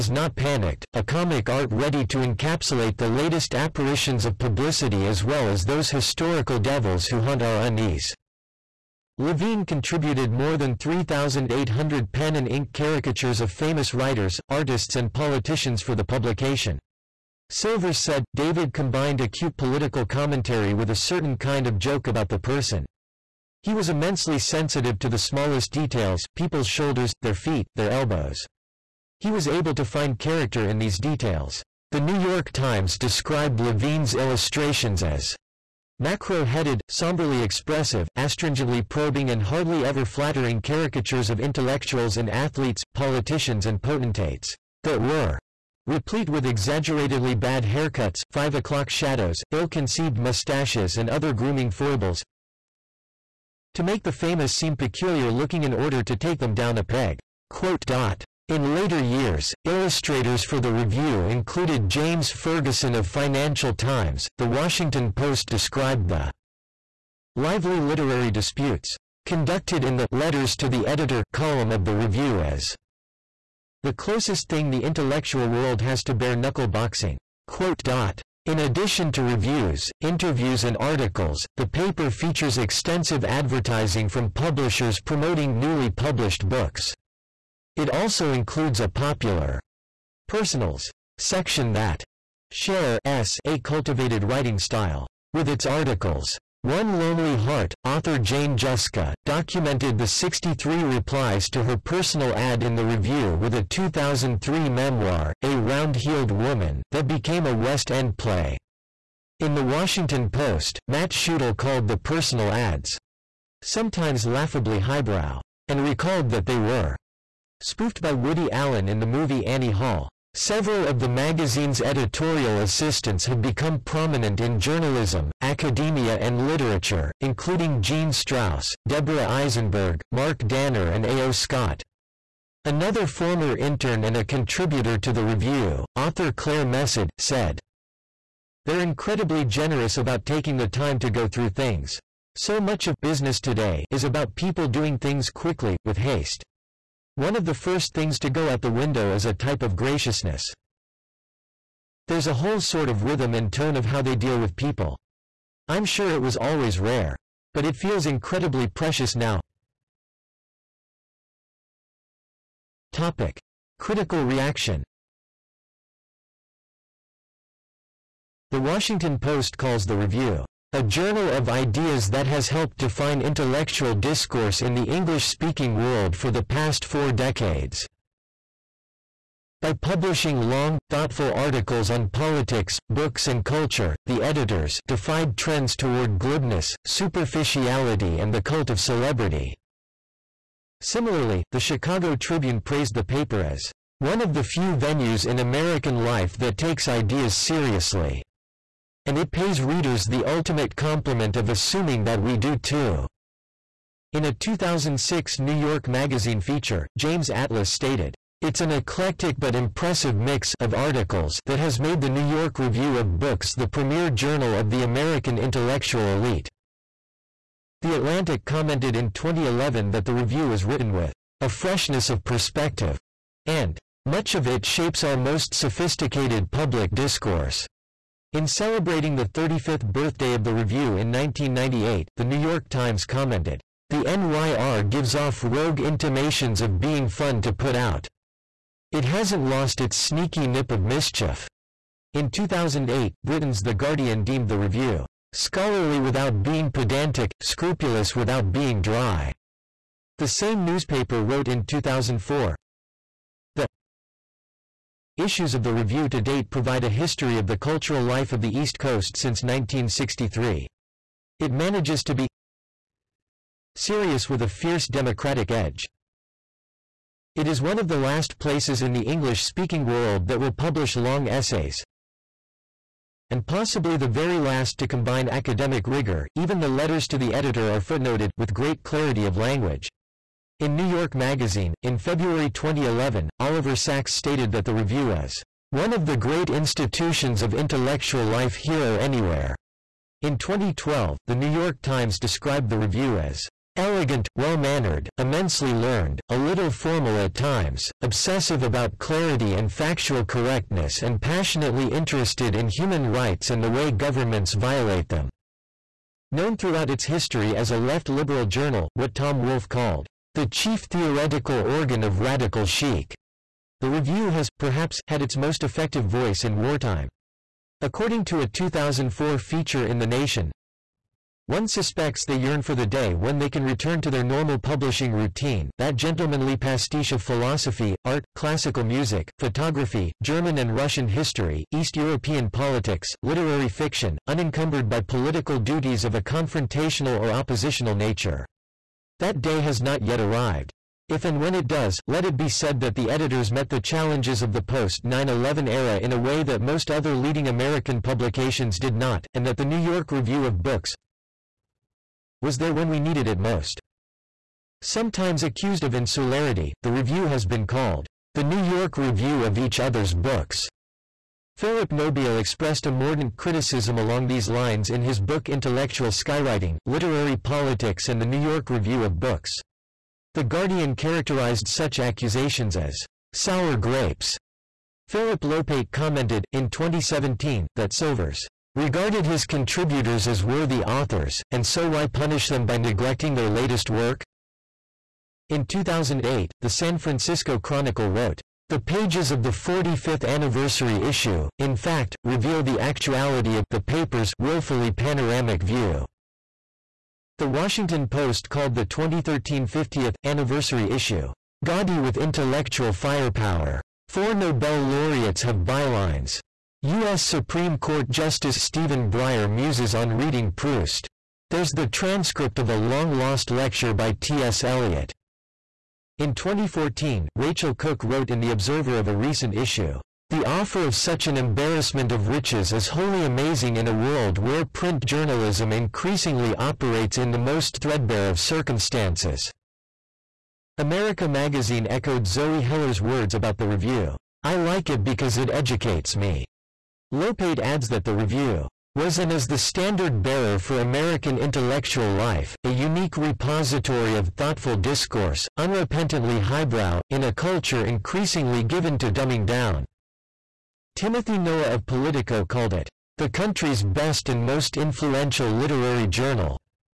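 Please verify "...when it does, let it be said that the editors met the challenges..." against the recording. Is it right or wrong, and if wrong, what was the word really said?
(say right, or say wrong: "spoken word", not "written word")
right.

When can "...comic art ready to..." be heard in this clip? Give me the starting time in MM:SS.
00:01.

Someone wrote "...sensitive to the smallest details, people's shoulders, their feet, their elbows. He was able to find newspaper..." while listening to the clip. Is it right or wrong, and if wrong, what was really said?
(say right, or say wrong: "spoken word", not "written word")
wrong: "character", not "newspaper".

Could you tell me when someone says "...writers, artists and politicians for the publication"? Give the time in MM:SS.
00:13.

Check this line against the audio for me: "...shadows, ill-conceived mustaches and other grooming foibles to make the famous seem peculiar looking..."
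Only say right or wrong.
right.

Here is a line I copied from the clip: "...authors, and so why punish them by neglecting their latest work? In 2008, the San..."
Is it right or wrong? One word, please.
right.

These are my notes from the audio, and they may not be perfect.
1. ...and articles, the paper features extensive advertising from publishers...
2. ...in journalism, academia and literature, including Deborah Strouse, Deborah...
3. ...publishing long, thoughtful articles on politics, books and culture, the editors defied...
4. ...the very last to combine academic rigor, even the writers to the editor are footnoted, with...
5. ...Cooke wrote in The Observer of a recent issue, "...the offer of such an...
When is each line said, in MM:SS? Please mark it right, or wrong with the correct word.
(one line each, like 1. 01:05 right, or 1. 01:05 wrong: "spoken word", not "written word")
1. 01:20 right
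2. 02:04 wrong: "Jean", not "Deborah"
3. 02:59 right
4. 04:33 wrong: "letters", not "writers"
5. 06:57 right.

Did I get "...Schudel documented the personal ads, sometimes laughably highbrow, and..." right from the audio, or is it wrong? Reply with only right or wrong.
wrong.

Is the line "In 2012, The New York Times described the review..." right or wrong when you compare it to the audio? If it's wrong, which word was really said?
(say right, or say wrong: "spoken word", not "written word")
right.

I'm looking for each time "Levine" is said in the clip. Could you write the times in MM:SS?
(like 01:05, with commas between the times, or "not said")
00:09, 00:33.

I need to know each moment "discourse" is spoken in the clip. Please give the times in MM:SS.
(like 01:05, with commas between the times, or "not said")
02:53, 03:46, 07:24.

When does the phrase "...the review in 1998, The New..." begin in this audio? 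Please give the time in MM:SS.
03:50.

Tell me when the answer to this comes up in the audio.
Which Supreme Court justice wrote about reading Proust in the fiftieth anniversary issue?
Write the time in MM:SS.
06:48.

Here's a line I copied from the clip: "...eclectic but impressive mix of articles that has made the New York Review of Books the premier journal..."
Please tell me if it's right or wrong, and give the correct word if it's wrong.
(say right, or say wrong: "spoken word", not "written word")
right.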